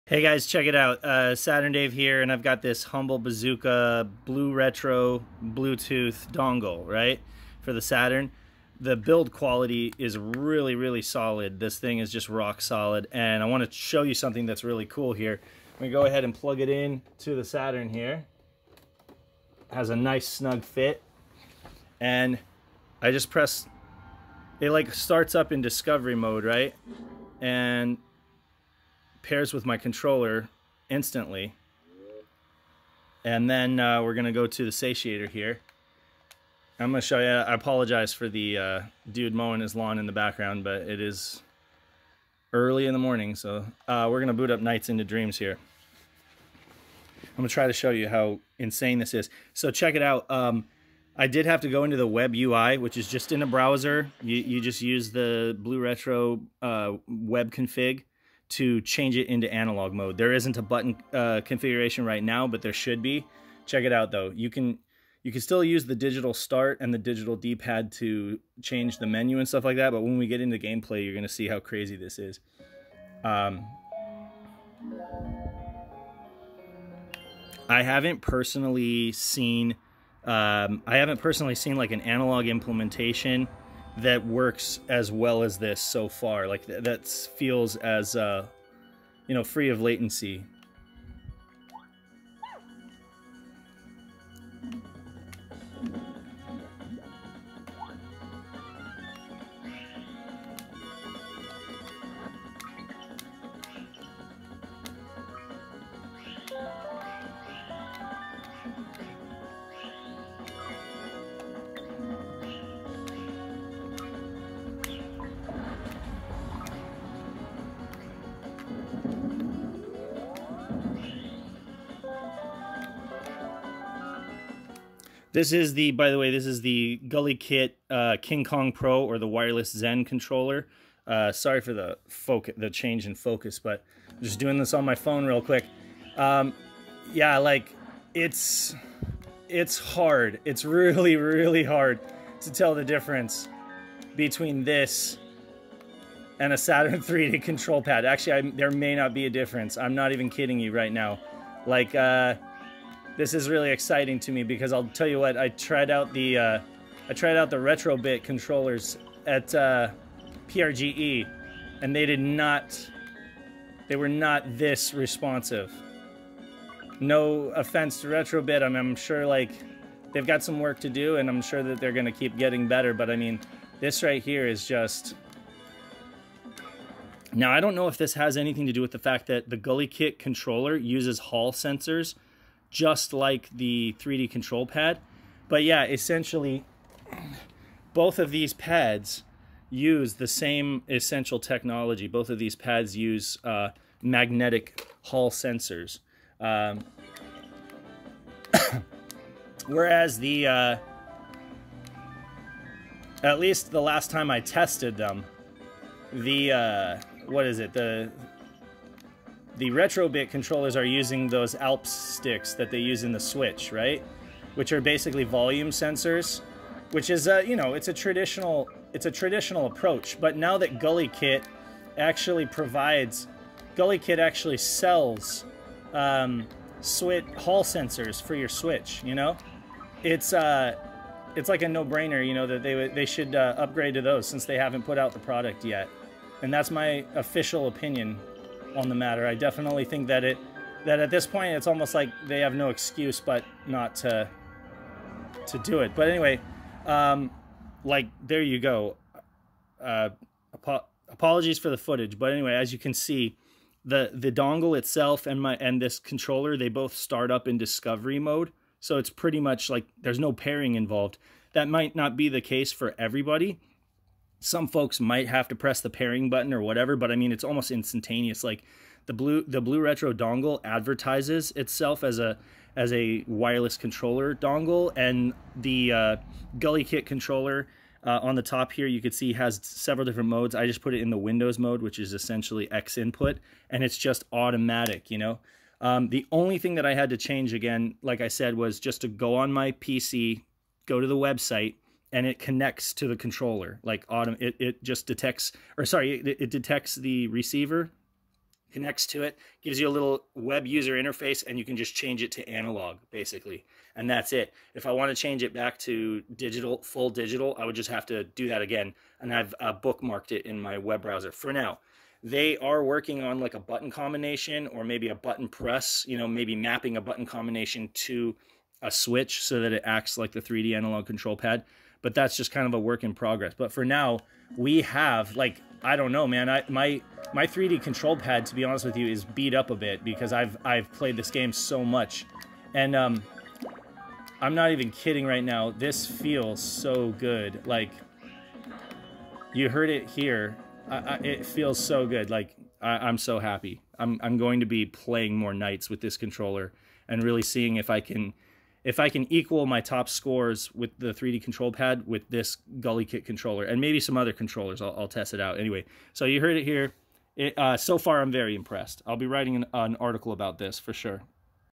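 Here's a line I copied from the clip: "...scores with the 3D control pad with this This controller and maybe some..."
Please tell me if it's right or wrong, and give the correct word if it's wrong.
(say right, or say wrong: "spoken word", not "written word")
wrong: "GuliKit", not "This".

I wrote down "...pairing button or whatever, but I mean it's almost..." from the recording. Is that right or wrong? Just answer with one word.
right.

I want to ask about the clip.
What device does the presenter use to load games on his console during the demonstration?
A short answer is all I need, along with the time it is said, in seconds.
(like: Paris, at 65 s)
Satiator, at 34 s.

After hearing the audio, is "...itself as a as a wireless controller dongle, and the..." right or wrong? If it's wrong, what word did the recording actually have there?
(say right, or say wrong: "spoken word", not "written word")
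right.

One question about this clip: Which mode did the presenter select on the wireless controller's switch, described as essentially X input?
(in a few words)
Windows mode.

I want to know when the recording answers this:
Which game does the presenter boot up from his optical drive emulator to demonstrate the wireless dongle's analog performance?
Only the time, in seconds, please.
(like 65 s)
44 s.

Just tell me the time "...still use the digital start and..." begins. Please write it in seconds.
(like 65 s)
65 s.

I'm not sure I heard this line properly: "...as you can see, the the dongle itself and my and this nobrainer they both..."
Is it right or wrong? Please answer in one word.
wrong.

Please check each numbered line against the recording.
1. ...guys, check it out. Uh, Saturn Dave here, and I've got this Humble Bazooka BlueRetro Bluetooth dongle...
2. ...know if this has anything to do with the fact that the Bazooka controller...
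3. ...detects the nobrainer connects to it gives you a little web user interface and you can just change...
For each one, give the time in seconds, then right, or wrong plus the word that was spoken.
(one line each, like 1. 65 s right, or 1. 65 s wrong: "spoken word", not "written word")
1. 0 s right
2. 177 s wrong: "GuliKit", not "Bazooka"
3. 296 s wrong: "receiver", not "nobrainer".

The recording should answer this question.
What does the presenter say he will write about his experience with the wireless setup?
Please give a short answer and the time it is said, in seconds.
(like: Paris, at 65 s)
An article, at 359 s.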